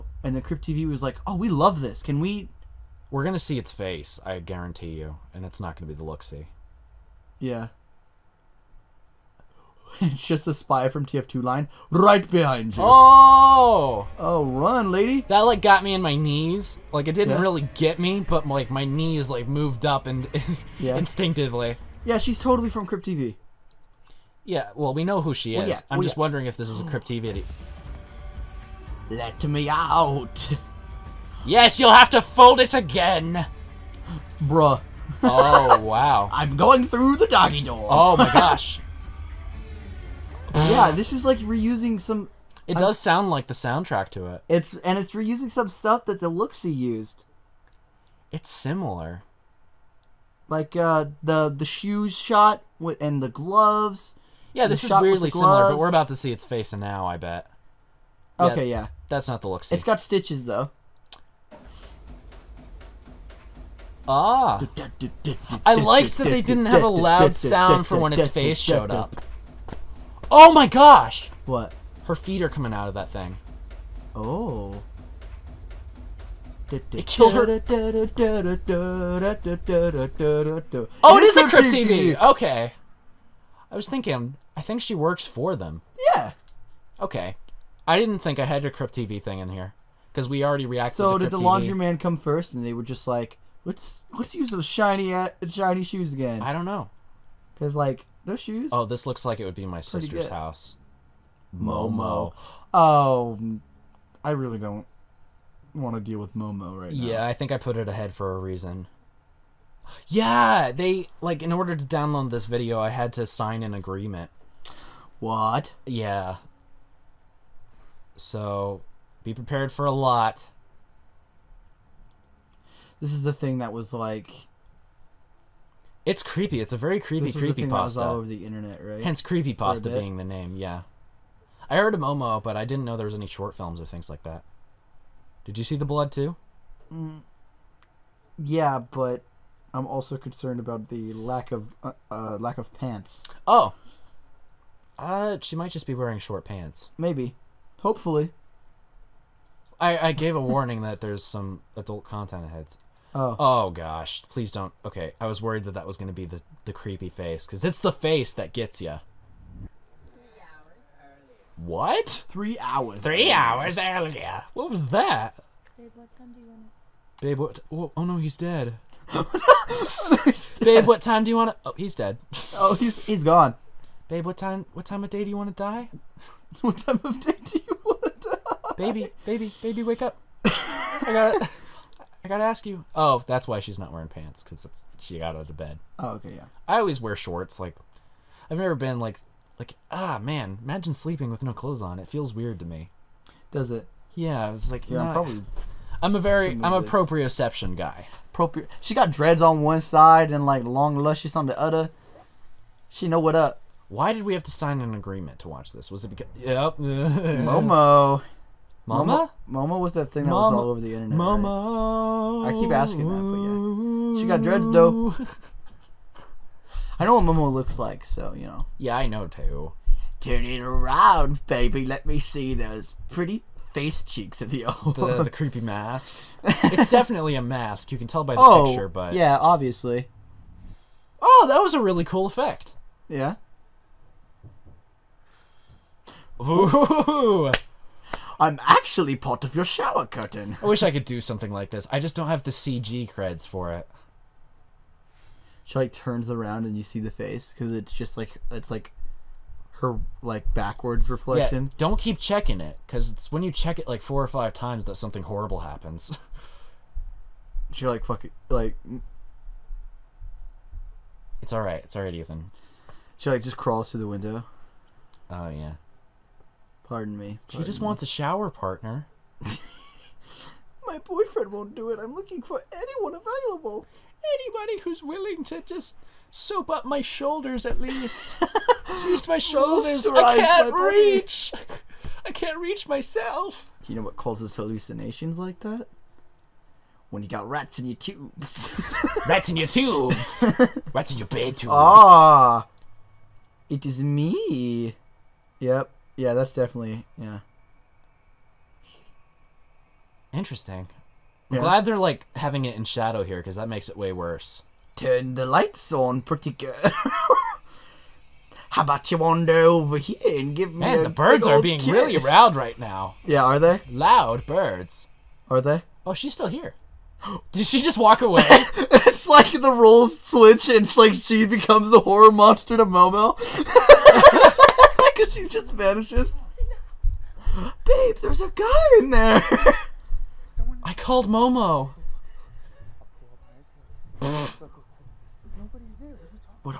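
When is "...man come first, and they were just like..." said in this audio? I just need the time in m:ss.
1:31.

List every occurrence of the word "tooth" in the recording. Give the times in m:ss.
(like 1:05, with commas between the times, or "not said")
not said.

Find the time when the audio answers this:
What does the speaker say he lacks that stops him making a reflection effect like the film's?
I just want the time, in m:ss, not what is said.
4:02.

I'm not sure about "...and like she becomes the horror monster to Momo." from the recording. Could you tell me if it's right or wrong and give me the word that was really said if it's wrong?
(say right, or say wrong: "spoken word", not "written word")
right.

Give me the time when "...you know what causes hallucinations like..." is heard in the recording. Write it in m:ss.
4:43.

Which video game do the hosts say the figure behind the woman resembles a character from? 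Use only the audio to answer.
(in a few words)
TF2.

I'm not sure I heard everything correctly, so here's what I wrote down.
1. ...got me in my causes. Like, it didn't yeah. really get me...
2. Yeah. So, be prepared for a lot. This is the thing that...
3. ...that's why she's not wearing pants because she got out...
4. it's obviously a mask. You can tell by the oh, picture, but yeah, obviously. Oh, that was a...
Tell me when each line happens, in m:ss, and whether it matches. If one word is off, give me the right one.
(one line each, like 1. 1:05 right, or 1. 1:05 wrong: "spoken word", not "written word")
1. 0:15 wrong: "knees", not "causes"
2. 1:55 right
3. 3:03 right
4. 3:46 wrong: "definitely", not "obviously".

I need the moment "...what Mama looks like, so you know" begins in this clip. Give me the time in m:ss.
3:37.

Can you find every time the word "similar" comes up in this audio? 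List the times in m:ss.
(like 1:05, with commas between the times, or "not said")
0:48, 0:55.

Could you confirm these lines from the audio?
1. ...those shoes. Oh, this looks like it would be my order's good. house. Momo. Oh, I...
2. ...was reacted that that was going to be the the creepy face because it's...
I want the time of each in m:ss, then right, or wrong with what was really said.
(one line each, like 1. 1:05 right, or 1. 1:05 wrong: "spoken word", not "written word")
1. 1:38 wrong: "sister", not "order"
2. 2:35 wrong: "worried", not "reacted".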